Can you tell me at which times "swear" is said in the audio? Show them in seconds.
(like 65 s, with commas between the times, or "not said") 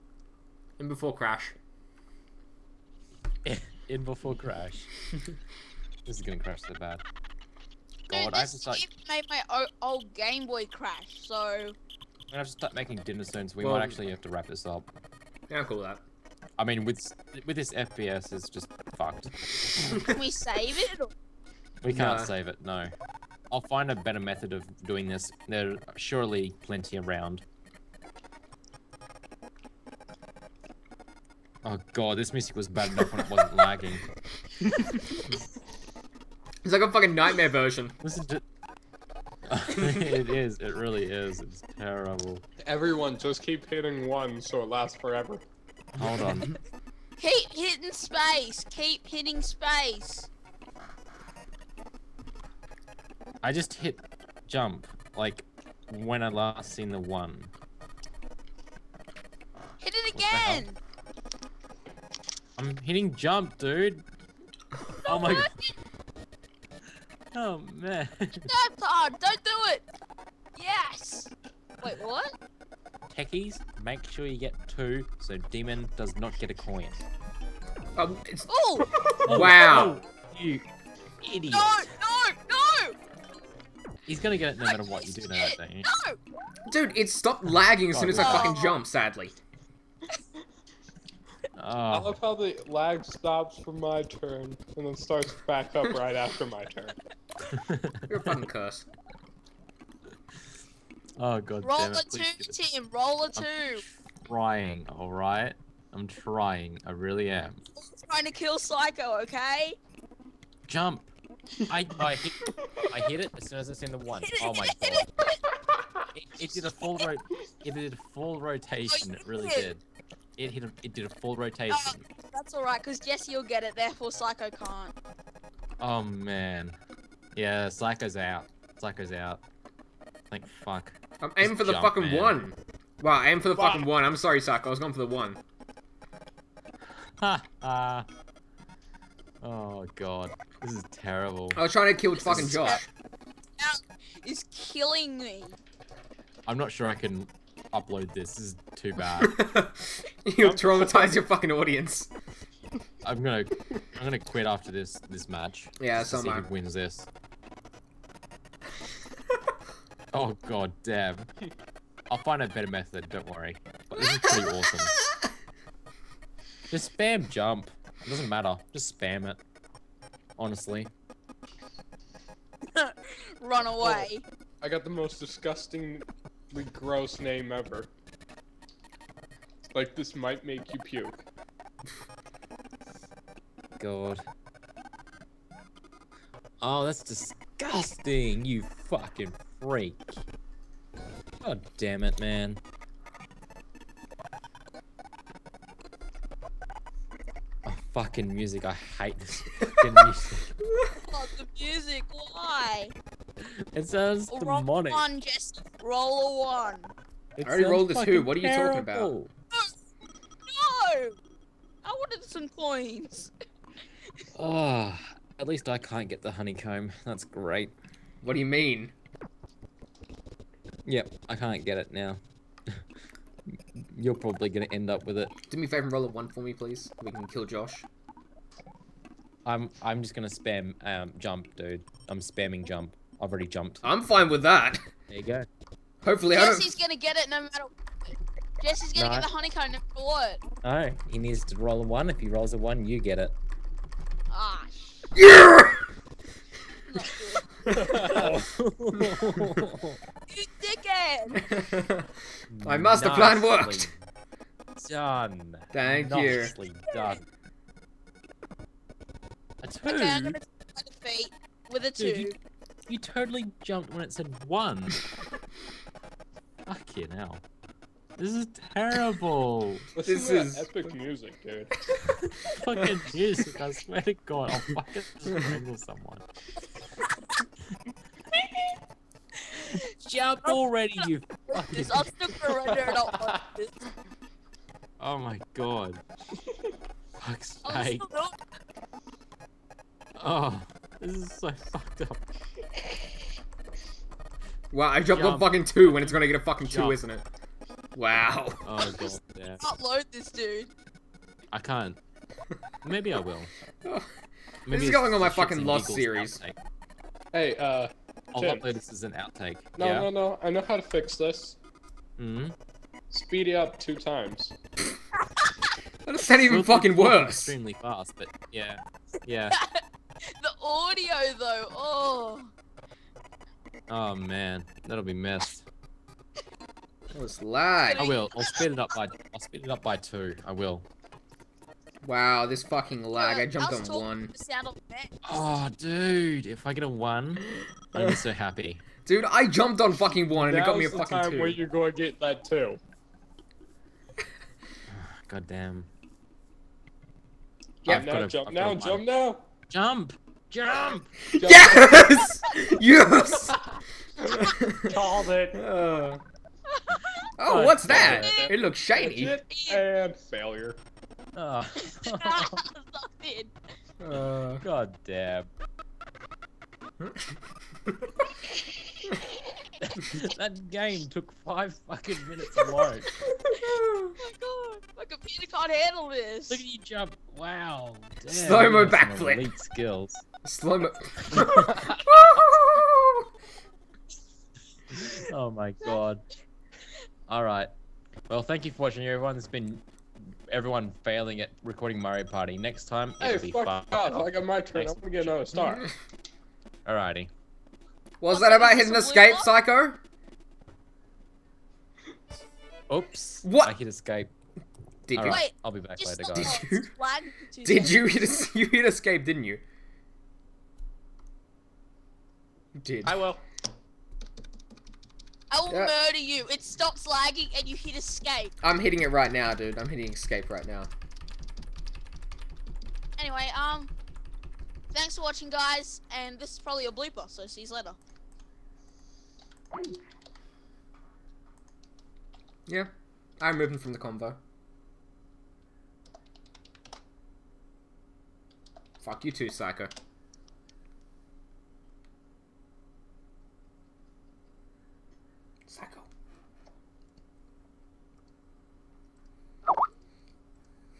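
273 s.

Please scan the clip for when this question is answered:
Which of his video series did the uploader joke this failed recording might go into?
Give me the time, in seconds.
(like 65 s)
305 s.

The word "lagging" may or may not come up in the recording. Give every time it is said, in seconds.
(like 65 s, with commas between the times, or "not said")
33 s, 87 s, 417 s.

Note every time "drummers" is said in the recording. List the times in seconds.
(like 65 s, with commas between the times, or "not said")
not said.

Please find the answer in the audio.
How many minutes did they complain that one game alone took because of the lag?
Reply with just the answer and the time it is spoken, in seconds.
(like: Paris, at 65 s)
5, at 371 s.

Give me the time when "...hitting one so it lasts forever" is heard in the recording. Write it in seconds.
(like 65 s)
43 s.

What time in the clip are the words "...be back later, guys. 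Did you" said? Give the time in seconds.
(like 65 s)
405 s.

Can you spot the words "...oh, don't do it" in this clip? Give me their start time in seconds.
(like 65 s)
68 s.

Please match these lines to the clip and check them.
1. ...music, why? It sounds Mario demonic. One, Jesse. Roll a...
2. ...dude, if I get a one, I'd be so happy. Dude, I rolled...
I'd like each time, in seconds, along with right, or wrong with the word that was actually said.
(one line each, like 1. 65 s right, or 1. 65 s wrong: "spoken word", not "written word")
1. 201 s wrong: "Wrong", not "Mario"
2. 335 s wrong: "jumped", not "rolled".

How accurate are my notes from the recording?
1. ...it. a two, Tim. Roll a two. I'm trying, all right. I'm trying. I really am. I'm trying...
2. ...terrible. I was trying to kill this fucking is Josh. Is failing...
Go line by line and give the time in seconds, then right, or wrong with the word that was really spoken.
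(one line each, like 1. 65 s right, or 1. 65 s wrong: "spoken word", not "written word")
1. 101 s right
2. 140 s wrong: "killing", not "failing".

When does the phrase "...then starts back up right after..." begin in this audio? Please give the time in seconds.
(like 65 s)
94 s.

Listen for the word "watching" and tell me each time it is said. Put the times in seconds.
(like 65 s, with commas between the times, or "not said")
388 s, 425 s.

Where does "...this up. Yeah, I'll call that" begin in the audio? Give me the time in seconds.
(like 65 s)
14 s.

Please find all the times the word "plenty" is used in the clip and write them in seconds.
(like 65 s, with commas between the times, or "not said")
26 s.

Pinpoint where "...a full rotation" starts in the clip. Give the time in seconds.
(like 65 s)
121 s.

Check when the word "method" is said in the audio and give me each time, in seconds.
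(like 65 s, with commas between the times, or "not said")
24 s, 162 s.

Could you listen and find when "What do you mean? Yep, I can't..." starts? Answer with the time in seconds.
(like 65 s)
218 s.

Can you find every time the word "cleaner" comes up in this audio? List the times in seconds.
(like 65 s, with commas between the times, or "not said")
not said.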